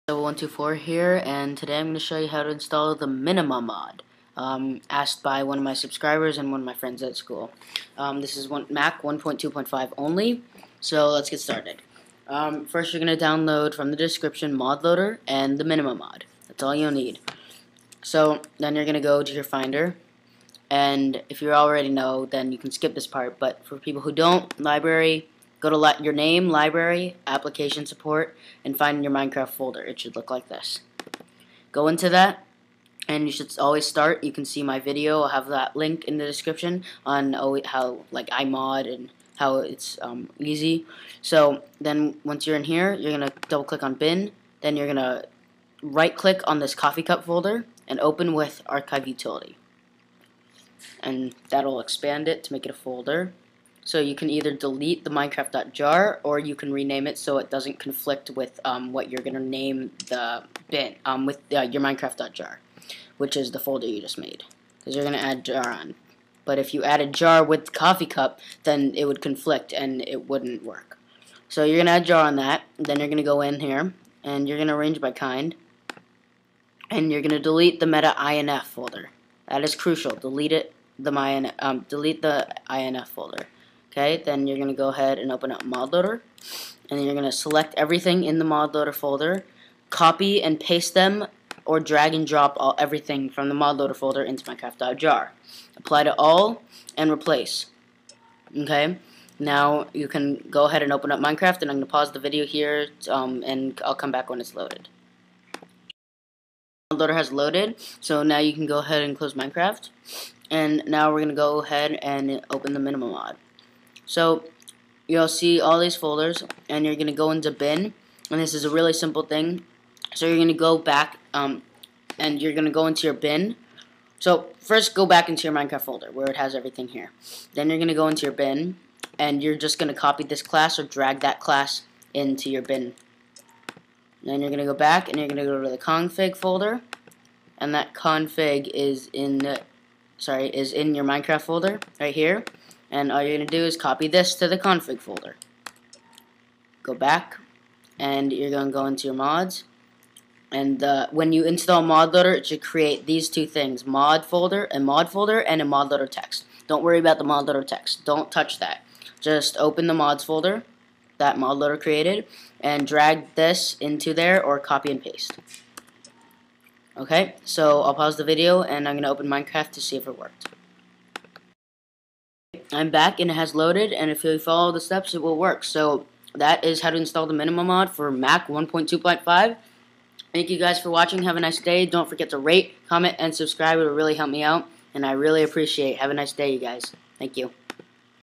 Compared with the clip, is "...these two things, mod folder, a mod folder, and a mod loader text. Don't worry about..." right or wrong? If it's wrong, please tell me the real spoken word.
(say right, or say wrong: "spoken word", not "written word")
right.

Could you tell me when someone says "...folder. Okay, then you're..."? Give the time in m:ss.
1:23.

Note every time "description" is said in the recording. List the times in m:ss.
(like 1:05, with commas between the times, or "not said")
0:13, 0:36.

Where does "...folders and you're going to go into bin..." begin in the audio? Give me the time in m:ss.
1:55.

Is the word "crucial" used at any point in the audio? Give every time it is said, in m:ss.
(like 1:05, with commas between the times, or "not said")
1:19.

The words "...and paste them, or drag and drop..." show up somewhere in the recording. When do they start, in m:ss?
1:30.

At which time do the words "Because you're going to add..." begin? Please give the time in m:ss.
1:04.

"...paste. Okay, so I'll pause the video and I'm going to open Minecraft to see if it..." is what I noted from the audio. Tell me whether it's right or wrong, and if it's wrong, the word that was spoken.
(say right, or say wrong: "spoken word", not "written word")
right.